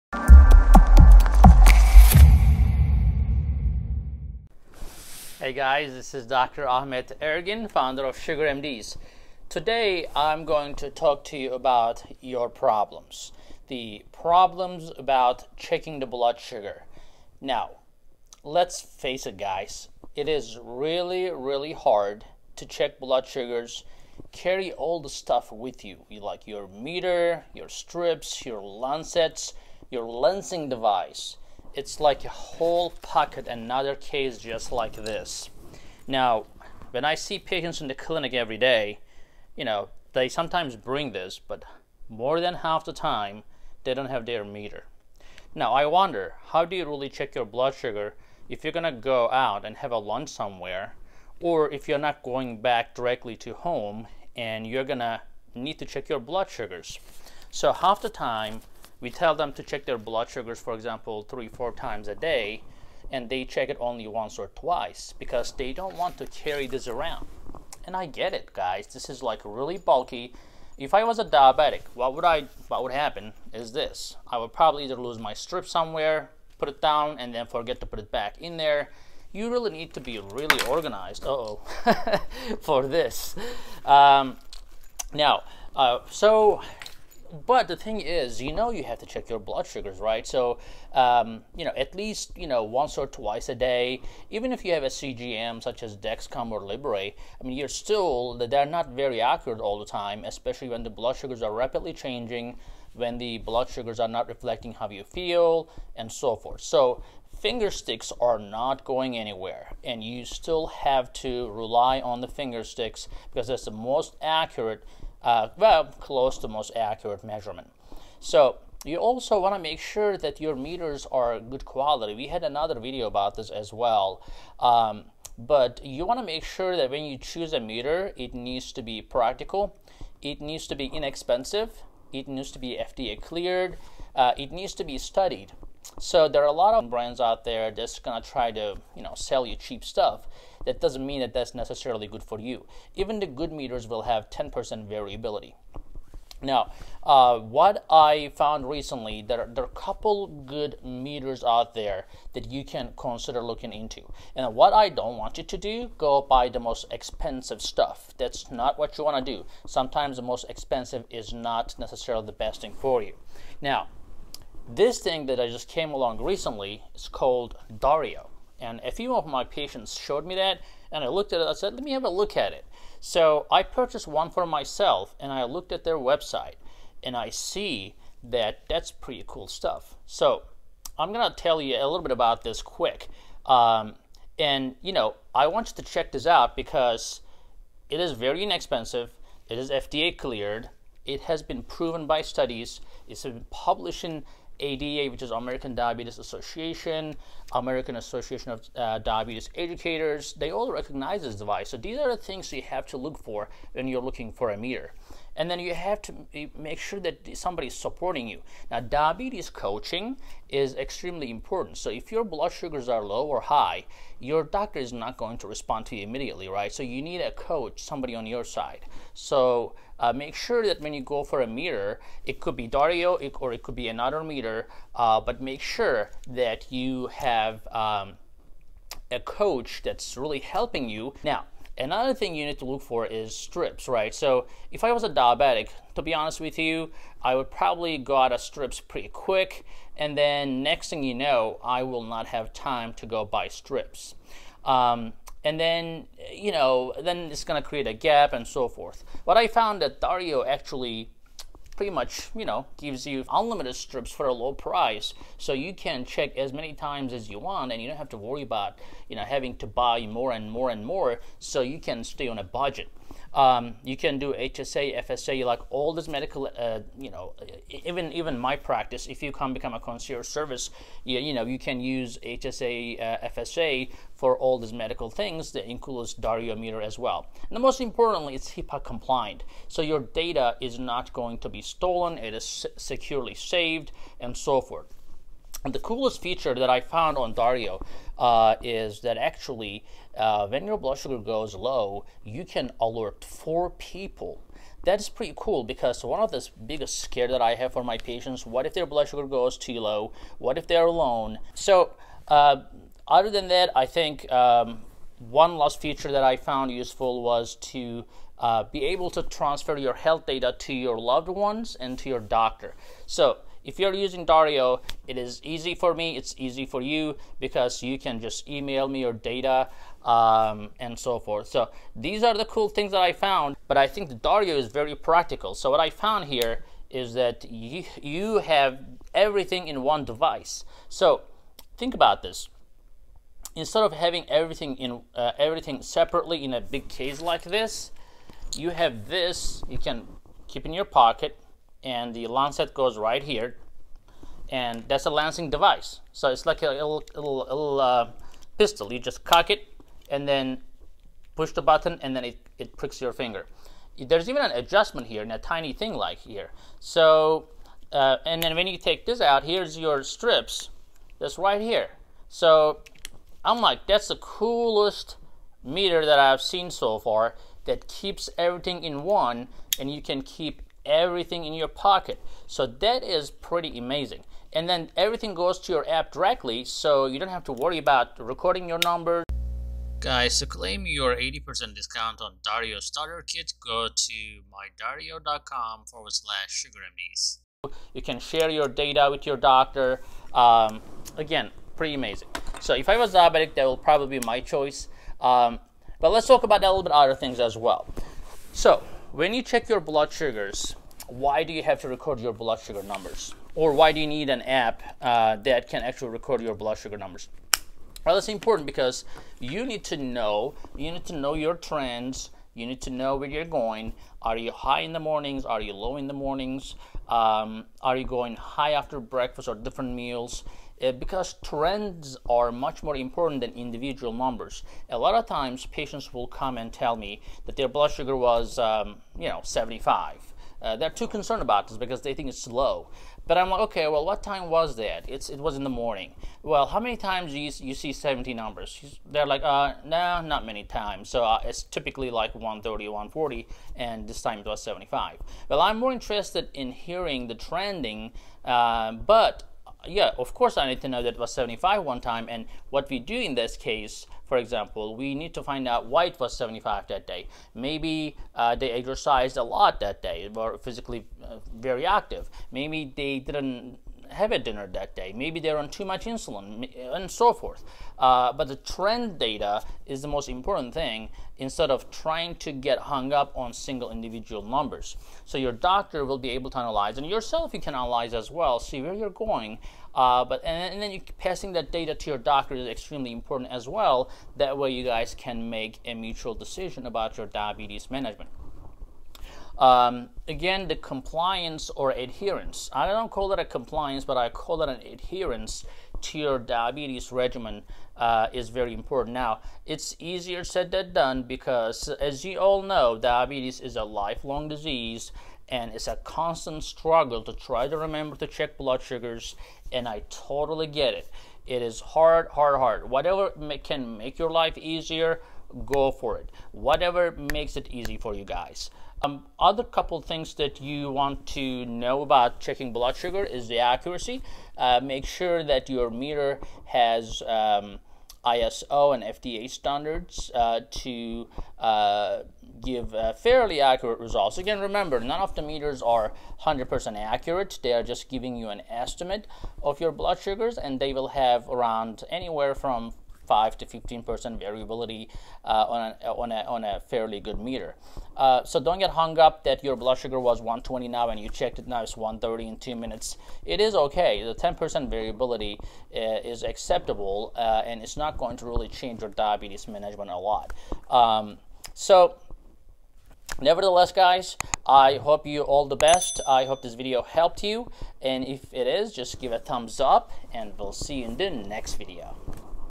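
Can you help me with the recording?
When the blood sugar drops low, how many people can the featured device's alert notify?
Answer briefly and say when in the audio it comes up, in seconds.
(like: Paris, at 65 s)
4, at 293 s.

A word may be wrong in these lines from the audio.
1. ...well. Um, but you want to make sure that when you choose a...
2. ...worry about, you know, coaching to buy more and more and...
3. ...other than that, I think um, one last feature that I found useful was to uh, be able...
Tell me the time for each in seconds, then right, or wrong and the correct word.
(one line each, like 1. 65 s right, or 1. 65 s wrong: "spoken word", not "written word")
1. 123 s right
2. 258 s wrong: "having", not "coaching"
3. 303 s right.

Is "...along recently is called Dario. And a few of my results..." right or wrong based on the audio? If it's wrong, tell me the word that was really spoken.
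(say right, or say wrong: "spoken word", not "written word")
wrong: "patients", not "results".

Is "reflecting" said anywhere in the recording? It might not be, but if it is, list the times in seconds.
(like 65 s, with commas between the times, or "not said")
104 s.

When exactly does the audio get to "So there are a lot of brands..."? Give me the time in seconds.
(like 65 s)
135 s.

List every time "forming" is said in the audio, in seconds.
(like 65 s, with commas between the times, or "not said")
not said.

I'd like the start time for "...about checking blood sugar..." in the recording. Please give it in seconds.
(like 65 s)
522 s.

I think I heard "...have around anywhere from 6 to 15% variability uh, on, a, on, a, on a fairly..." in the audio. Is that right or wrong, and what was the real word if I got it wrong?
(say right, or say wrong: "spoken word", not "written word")
wrong: "5", not "6".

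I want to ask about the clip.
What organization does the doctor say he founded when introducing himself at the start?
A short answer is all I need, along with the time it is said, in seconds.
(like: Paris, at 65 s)
Sugar MDs, at 8 s.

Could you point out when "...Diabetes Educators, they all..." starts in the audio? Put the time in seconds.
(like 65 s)
198 s.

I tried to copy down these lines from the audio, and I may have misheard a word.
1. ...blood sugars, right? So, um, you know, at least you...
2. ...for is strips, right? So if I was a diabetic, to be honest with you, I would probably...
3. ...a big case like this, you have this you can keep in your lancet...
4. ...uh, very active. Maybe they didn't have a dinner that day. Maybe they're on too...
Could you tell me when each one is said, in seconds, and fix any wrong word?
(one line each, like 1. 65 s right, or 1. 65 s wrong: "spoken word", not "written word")
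1. 89 s right
2. 232 s right
3. 336 s wrong: "pocket", not "lancet"
4. 461 s right.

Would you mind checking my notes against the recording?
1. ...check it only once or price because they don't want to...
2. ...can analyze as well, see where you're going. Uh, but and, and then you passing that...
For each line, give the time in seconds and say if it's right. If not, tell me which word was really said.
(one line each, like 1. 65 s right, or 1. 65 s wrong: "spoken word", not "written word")
1. 63 s wrong: "twice", not "price"
2. 477 s right.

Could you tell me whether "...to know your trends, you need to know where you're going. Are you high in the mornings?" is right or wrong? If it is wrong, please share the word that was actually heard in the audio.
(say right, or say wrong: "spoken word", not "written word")
right.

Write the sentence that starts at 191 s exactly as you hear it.
It has been proven by studies.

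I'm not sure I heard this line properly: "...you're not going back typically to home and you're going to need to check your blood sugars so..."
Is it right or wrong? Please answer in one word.
wrong.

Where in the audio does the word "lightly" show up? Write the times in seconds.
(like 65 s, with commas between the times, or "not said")
not said.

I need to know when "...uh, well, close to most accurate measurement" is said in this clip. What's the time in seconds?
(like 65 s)
115 s.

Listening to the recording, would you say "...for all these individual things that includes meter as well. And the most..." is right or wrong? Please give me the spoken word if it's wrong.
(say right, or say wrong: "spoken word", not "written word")
wrong: "medical", not "individual".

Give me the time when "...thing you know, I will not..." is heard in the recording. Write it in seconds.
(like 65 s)
240 s.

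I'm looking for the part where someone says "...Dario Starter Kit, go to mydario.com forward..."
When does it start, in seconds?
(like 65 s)
382 s.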